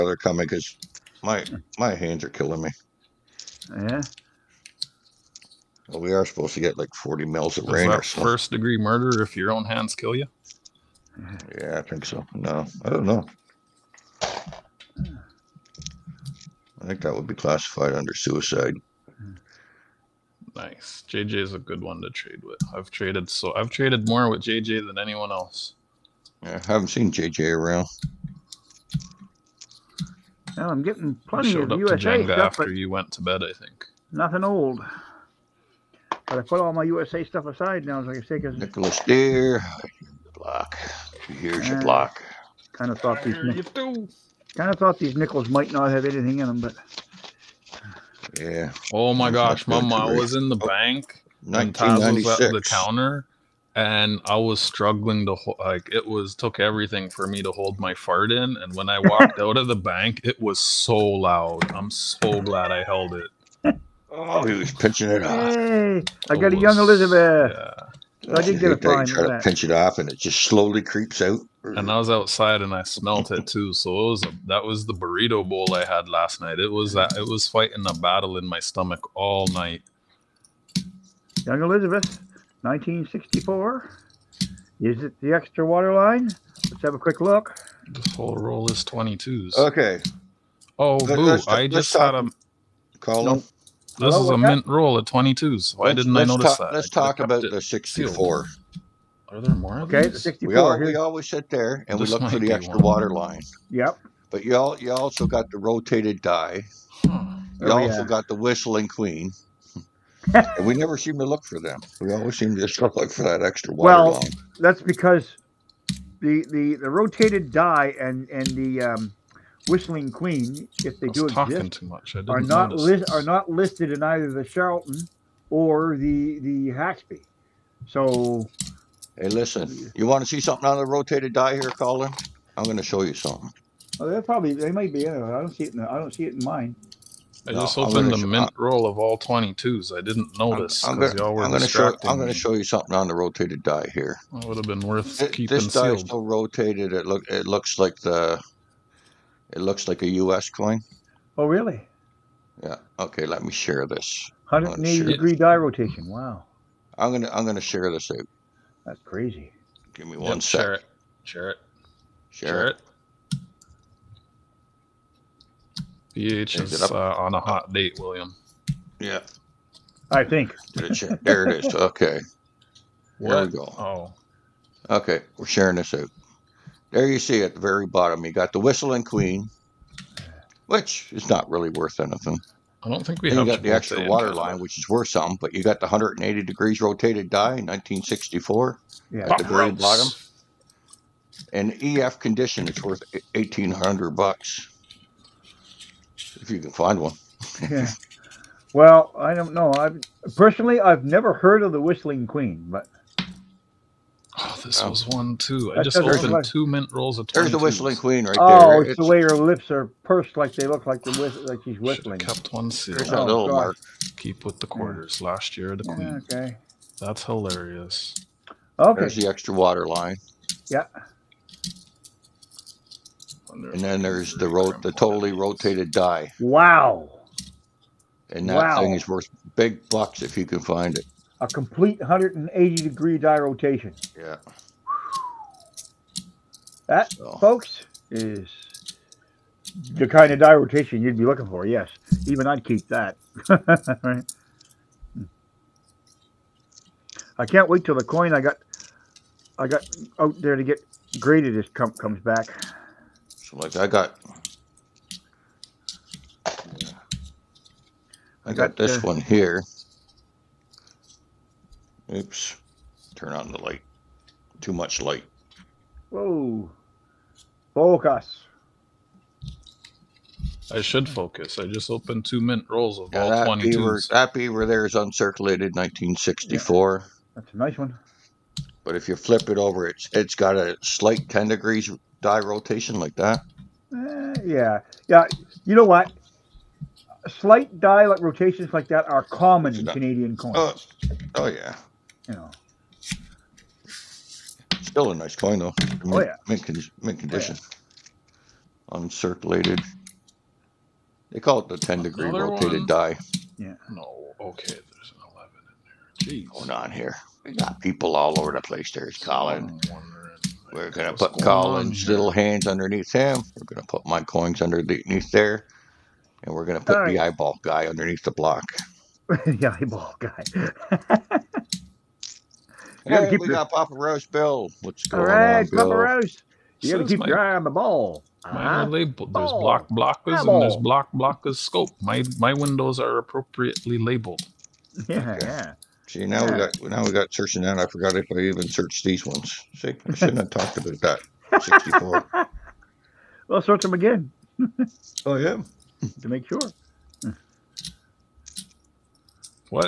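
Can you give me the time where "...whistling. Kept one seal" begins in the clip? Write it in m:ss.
3:31.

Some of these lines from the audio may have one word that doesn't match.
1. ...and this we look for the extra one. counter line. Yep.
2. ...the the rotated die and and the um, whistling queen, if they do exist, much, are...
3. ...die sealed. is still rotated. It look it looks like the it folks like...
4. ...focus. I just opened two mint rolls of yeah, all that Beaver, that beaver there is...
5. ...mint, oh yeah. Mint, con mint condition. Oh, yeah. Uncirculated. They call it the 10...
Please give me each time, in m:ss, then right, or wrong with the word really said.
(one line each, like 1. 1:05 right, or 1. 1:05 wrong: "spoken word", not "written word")
1. 1:41 wrong: "water", not "counter"
2. 1:56 right
3. 2:25 wrong: "looks", not "folks"
4. 4:31 right
5. 4:55 right.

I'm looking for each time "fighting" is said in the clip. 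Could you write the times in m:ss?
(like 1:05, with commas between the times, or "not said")
1:17.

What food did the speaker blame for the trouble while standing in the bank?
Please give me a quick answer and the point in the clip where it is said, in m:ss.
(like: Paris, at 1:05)
burrito bowl, at 1:14.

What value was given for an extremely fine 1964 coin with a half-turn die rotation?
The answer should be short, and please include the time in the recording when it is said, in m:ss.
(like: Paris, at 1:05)
1800 bucks, at 3:13.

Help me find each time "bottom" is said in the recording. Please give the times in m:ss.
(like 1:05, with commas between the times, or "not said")
2:57, 3:09.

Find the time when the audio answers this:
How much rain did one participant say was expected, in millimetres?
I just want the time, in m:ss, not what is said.
0:06.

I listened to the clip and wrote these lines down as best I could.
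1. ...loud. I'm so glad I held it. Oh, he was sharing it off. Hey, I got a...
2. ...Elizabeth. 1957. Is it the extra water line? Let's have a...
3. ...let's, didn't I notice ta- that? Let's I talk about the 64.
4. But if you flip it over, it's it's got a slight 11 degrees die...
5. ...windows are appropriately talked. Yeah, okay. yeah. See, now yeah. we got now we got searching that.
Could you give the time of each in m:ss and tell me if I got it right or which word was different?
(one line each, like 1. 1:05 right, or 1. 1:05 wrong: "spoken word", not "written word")
1. 1:00 wrong: "pinching", not "sharing"
2. 1:21 wrong: "1964", not "1957"
3. 1:35 right
4. 4:38 wrong: "10", not "11"
5. 5:32 wrong: "labeled", not "talked".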